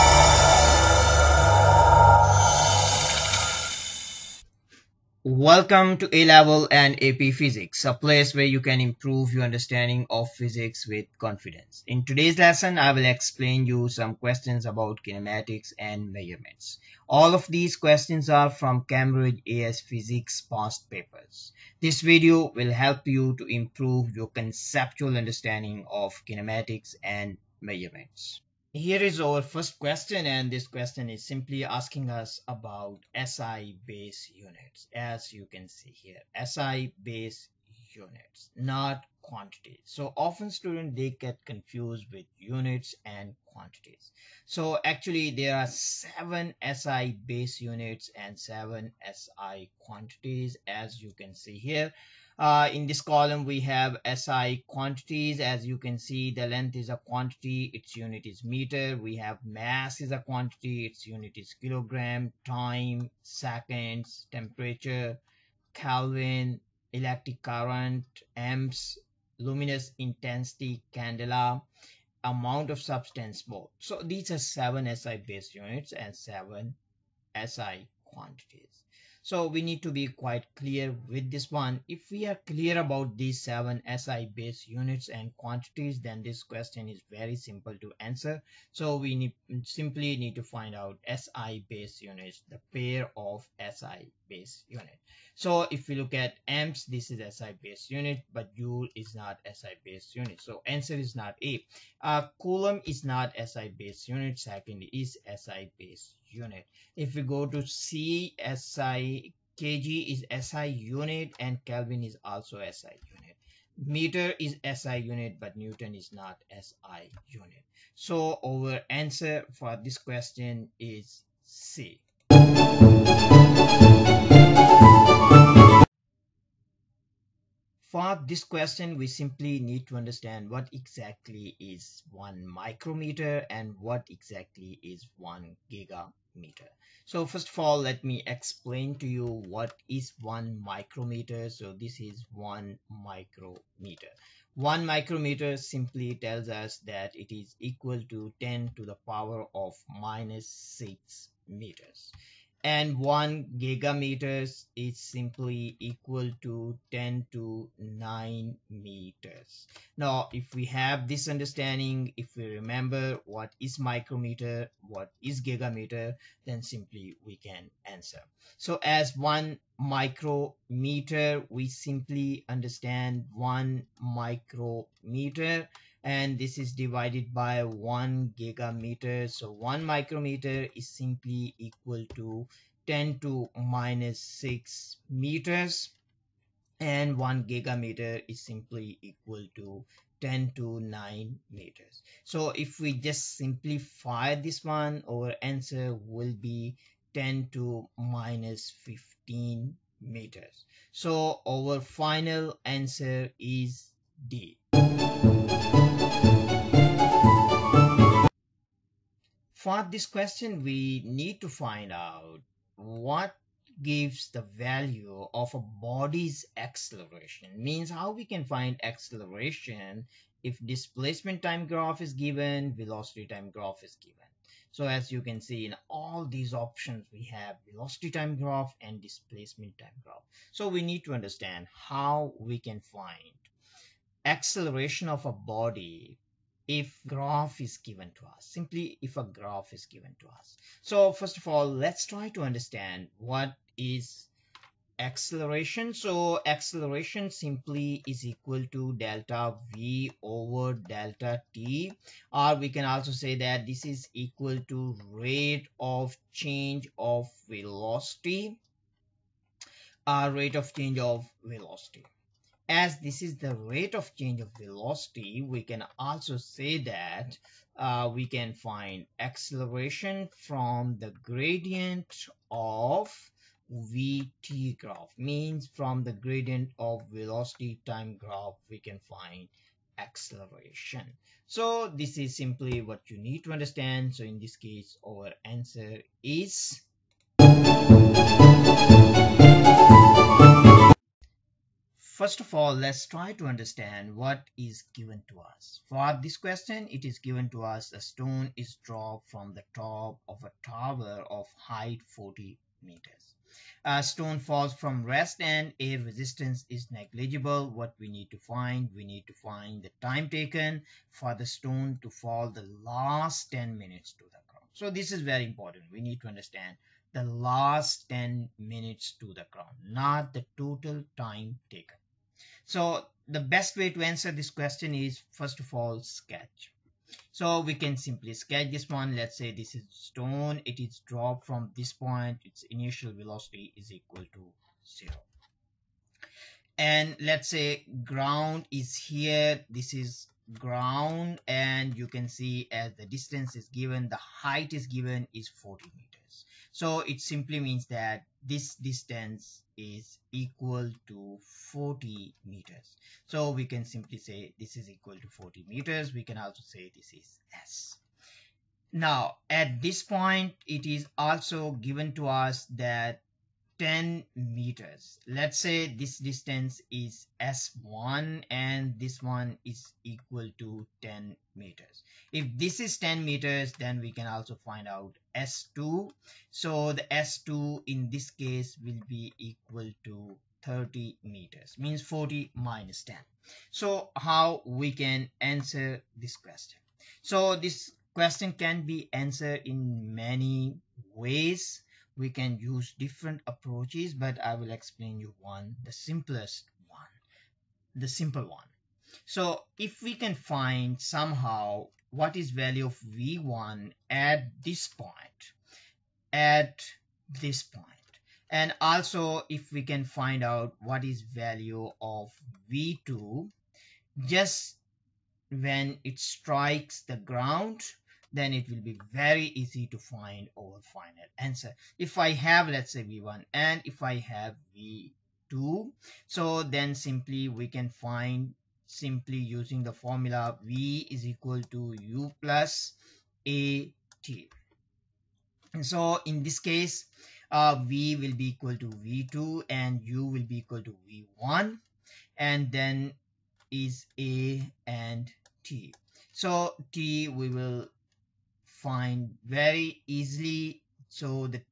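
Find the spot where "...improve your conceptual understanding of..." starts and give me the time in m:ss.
0:23.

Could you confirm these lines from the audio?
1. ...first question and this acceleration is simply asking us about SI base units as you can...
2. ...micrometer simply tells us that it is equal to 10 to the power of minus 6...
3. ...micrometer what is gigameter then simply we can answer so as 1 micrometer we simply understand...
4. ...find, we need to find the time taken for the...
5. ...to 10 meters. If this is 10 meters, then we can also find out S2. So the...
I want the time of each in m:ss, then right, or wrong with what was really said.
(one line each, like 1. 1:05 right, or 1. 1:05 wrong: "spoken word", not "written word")
1. 0:29 wrong: "question", not "acceleration"
2. 2:24 right
3. 2:43 right
4. 5:08 right
5. 6:10 right.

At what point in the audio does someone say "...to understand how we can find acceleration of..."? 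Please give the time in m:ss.
3:51.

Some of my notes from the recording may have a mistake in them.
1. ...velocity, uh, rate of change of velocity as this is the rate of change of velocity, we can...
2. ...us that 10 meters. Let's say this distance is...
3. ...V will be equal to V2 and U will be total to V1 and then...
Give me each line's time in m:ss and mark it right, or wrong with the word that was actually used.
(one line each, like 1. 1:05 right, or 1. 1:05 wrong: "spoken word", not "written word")
1. 4:17 right
2. 6:02 right
3. 7:17 wrong: "equal", not "total".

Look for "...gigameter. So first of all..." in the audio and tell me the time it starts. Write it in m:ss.
2:15.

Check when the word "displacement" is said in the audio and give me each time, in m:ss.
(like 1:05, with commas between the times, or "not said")
3:40, 3:49.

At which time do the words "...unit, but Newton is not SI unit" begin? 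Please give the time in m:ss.
1:54.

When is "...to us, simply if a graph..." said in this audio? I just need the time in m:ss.
3:58.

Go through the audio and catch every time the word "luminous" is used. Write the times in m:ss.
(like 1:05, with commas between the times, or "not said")
1:09.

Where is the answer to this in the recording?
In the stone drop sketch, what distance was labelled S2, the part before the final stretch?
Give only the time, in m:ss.
6:20.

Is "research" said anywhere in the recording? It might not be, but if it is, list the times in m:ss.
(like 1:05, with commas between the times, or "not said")
not said.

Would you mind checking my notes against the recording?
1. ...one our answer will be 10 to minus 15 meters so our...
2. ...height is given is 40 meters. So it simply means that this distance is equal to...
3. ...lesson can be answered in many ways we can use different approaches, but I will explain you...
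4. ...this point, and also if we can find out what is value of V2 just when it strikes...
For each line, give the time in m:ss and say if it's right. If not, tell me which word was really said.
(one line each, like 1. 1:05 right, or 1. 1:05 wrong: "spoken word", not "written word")
1. 3:14 right
2. 5:44 right
3. 6:28 wrong: "question", not "lesson"
4. 6:47 right.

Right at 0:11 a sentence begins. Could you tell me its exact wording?
In today's lesson, I will explain you some questions about kinematics and measurements.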